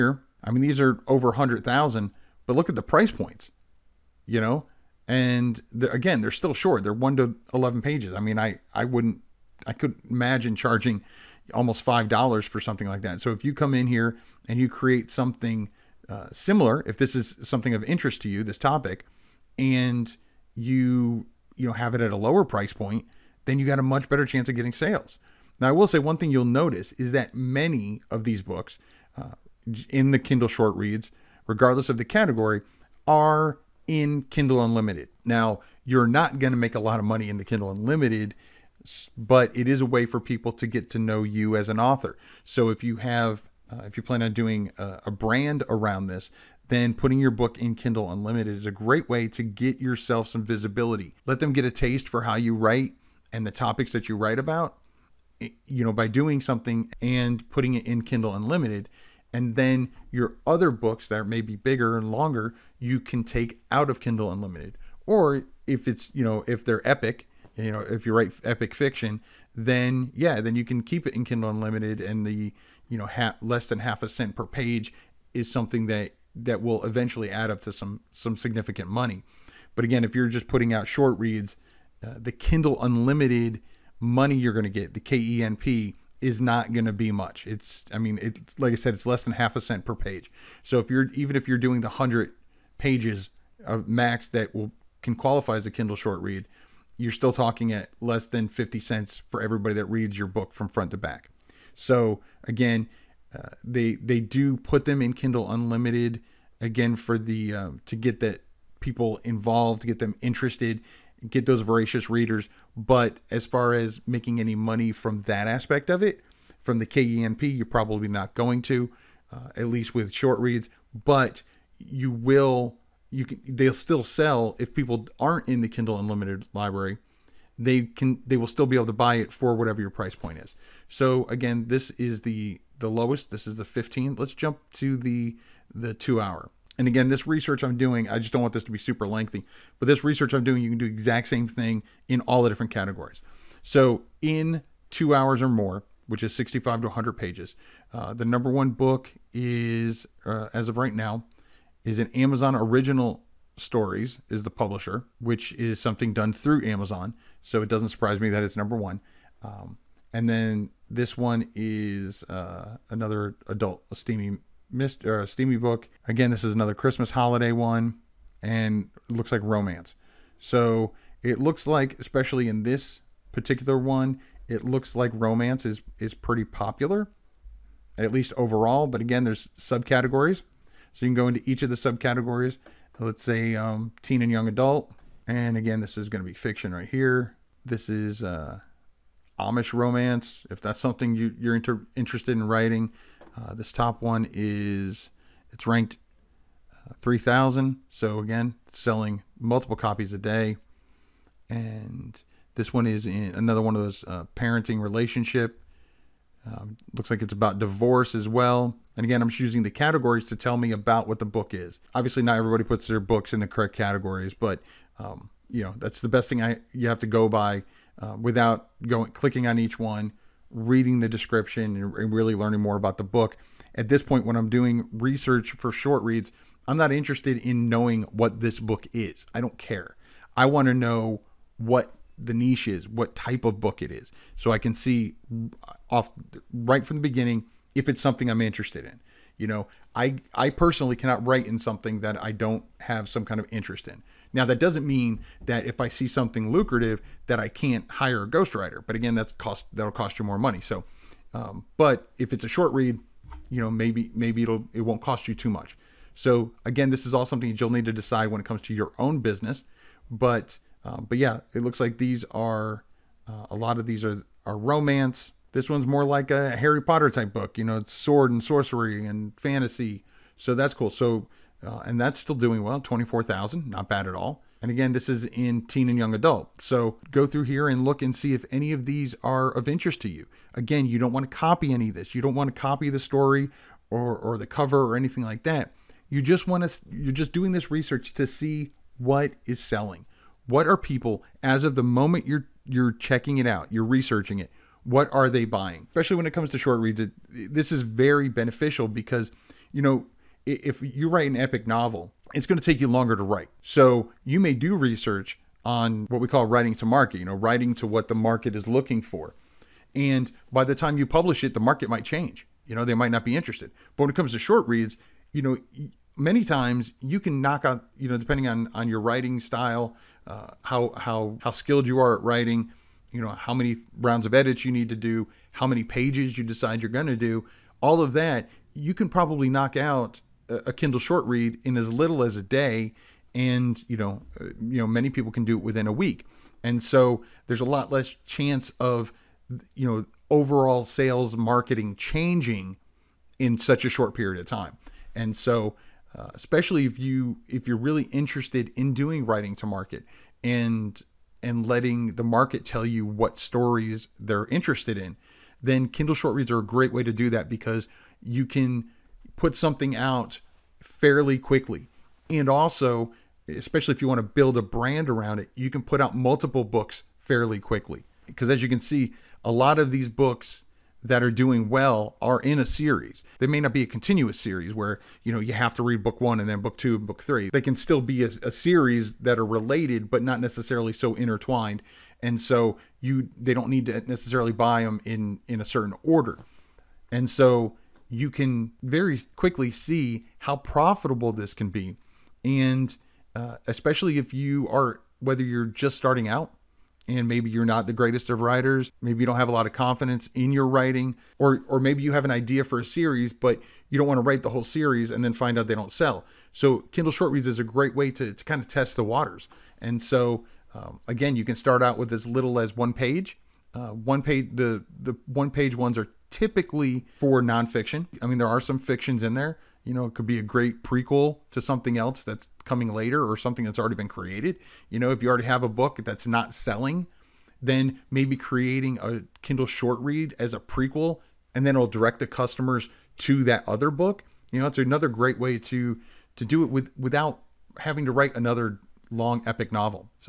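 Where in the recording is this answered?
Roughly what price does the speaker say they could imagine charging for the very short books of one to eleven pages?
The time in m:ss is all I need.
0:11.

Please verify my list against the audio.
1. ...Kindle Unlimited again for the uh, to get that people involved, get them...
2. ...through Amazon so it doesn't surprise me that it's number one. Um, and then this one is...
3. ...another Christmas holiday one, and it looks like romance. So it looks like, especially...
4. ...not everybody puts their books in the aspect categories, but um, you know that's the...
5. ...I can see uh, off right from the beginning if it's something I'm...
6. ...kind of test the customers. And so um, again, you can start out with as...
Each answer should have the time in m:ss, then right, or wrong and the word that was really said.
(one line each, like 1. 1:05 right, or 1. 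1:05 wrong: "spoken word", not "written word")
1. 1:45 right
2. 2:36 right
3. 2:46 right
4. 3:32 wrong: "correct", not "aspect"
5. 3:54 right
6. 6:48 wrong: "waters", not "customers".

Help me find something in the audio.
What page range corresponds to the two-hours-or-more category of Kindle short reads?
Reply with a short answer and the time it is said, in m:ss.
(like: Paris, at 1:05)
65 to 100 pages, at 2:26.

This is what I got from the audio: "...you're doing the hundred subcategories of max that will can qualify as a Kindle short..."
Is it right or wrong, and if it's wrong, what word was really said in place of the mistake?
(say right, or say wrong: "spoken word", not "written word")
wrong: "pages", not "subcategories".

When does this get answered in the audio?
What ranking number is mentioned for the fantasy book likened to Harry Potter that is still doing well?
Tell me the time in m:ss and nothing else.
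4:32.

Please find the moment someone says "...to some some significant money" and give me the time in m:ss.
1:17.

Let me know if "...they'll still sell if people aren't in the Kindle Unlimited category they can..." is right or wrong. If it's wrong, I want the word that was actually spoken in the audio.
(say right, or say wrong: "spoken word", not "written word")
wrong: "library", not "category".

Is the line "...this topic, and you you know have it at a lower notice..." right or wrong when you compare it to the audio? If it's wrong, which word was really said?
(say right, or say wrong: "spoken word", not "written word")
wrong: "price", not "notice".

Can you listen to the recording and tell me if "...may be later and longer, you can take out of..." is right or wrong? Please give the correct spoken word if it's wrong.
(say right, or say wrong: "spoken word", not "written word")
wrong: "bigger", not "later".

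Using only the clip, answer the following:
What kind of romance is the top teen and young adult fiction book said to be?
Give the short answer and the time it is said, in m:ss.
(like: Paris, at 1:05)
Amish romance, at 3:09.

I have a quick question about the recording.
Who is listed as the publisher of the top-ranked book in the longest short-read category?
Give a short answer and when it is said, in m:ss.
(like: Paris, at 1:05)
Amazon Original Stories, at 2:32.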